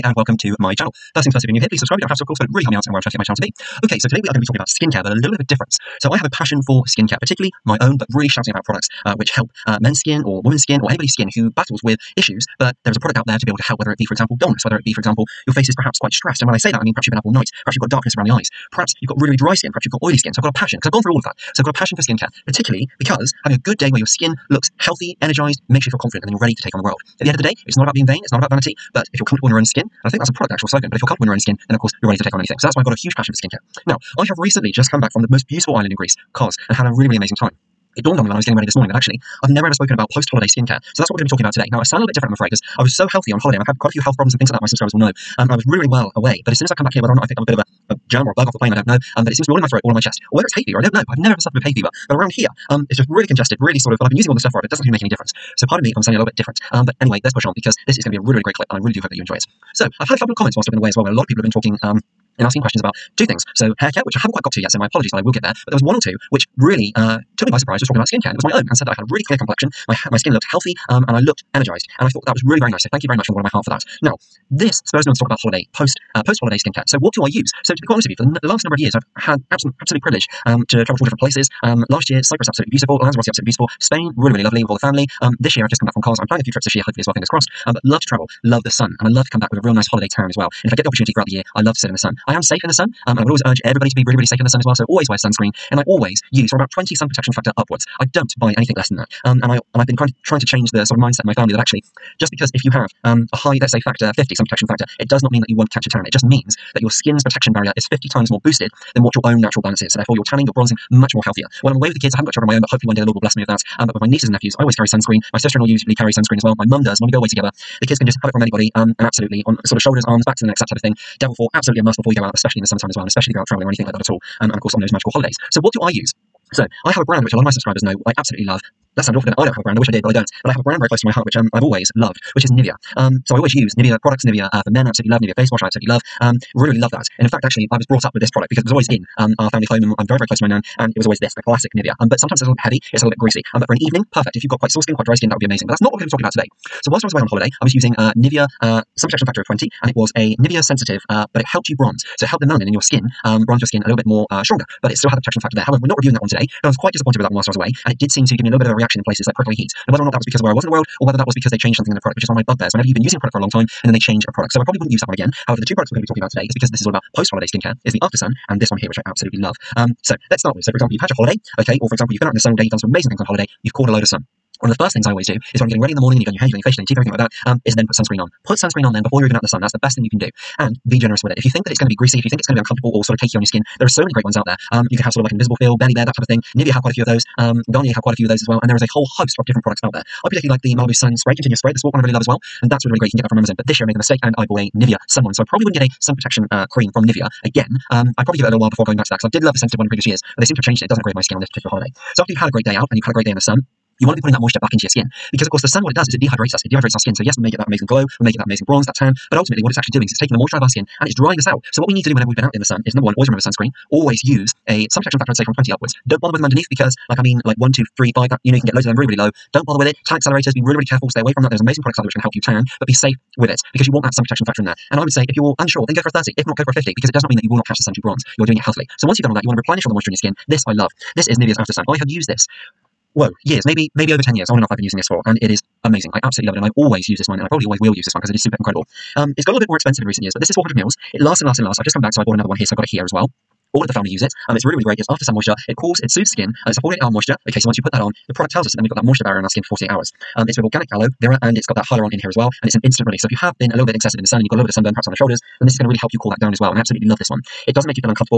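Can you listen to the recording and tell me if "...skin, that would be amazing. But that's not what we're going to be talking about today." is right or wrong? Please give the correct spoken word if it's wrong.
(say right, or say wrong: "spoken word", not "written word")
right.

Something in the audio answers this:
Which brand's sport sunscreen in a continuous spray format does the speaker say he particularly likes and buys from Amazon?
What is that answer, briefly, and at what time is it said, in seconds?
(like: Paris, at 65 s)
Malibu, at 190 s.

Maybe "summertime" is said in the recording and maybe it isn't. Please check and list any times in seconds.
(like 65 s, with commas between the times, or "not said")
122 s.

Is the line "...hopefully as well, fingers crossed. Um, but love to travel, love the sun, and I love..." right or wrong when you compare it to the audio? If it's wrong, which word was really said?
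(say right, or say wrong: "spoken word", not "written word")
right.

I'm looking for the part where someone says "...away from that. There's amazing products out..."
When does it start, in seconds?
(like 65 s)
221 s.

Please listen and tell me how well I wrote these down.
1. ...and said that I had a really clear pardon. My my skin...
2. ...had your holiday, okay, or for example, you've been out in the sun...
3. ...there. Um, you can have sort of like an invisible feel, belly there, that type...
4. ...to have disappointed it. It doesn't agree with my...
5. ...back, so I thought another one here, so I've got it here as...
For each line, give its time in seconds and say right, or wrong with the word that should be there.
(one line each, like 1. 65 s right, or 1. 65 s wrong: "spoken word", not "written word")
1. 68 s wrong: "complexion", not "pardon"
2. 170 s right
3. 184 s right
4. 200 s wrong: "changed", not "disappointed"
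5. 242 s wrong: "bought", not "thought".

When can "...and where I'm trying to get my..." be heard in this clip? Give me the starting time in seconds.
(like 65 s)
2 s.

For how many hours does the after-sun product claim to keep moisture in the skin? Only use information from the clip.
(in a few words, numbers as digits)
48 hours.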